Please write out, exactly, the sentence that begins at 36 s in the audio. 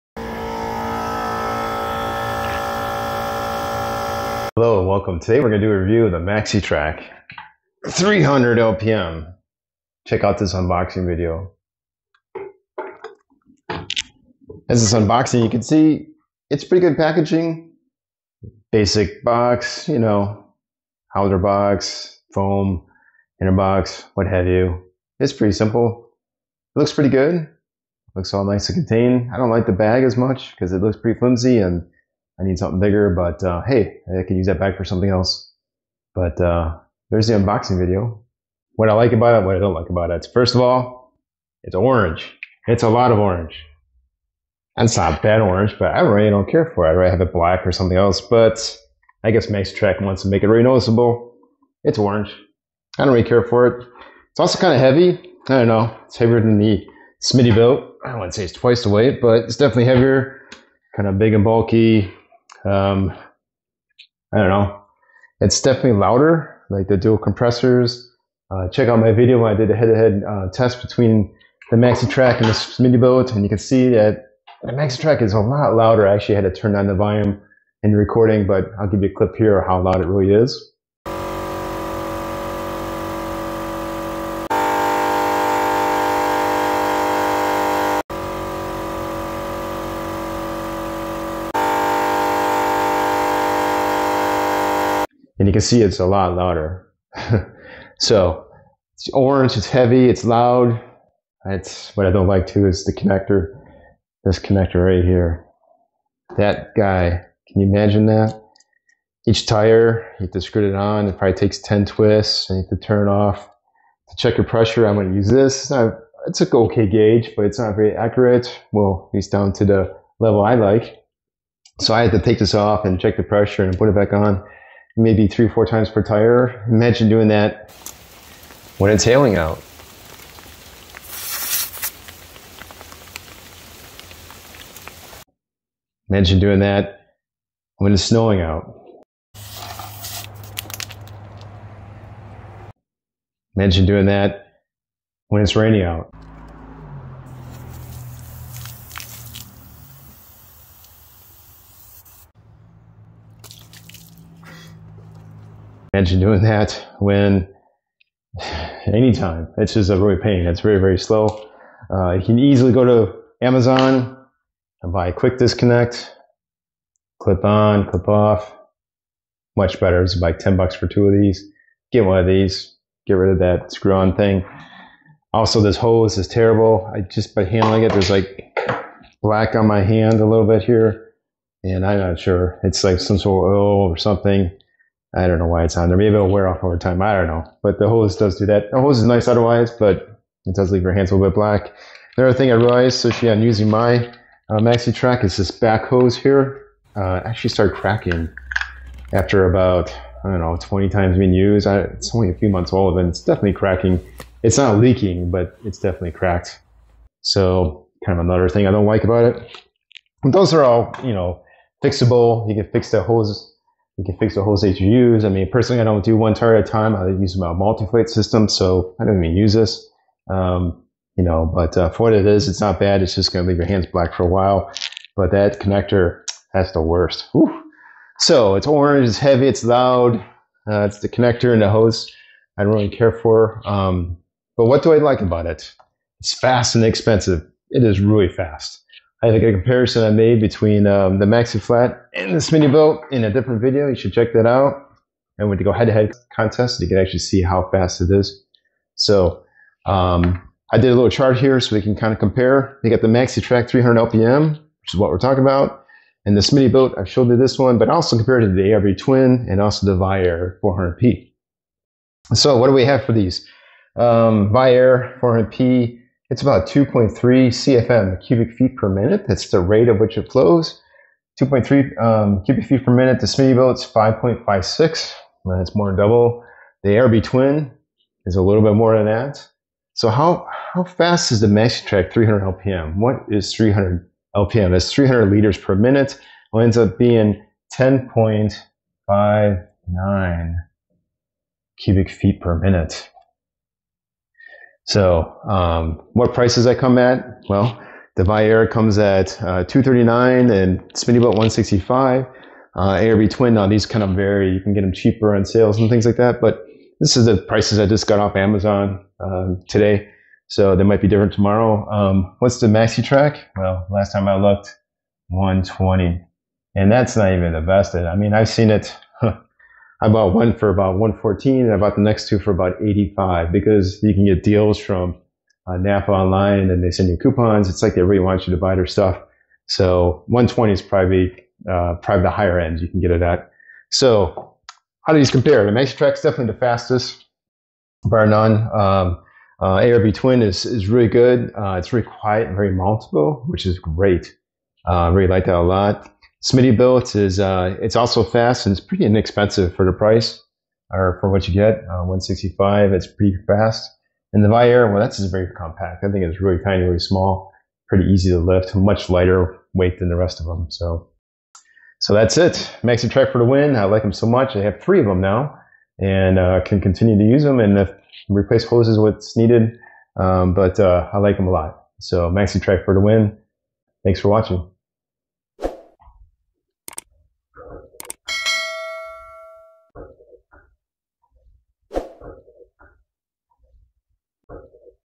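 But uh, there's the unboxing video.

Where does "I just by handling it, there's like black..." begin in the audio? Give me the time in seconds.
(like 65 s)
176 s.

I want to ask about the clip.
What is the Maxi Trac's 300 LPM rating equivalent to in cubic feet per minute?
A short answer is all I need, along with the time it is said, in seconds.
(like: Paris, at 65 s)
10.59, at 287 s.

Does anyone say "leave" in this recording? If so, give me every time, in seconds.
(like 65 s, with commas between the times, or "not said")
190 s, 223 s.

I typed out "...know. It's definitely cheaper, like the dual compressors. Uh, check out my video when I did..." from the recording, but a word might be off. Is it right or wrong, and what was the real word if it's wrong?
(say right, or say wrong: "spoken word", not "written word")
wrong: "louder", not "cheaper".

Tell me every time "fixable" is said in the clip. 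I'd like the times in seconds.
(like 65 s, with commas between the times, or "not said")
211 s.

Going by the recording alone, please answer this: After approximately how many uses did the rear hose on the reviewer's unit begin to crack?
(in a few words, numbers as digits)
20.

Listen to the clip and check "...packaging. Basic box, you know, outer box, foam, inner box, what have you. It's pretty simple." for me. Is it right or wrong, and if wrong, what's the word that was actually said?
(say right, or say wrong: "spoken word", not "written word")
right.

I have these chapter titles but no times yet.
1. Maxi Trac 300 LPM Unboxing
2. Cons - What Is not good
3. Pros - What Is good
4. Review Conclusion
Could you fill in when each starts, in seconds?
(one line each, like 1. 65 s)
1. 14 s
2. 39 s
3. 235 s
4. 360 s.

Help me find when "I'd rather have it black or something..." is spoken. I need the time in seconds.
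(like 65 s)
46 s.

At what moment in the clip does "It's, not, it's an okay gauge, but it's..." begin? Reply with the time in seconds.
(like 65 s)
115 s.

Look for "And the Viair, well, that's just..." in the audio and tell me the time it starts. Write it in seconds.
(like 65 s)
354 s.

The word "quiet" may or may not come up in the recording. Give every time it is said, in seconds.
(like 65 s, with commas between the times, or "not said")
342 s.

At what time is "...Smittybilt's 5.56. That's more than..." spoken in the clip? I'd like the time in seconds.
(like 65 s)
273 s.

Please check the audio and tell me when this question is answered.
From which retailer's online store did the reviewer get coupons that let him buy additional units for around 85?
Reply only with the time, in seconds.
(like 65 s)
325 s.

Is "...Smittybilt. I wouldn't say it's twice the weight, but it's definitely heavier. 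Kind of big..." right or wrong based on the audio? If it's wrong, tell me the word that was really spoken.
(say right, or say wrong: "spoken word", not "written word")
right.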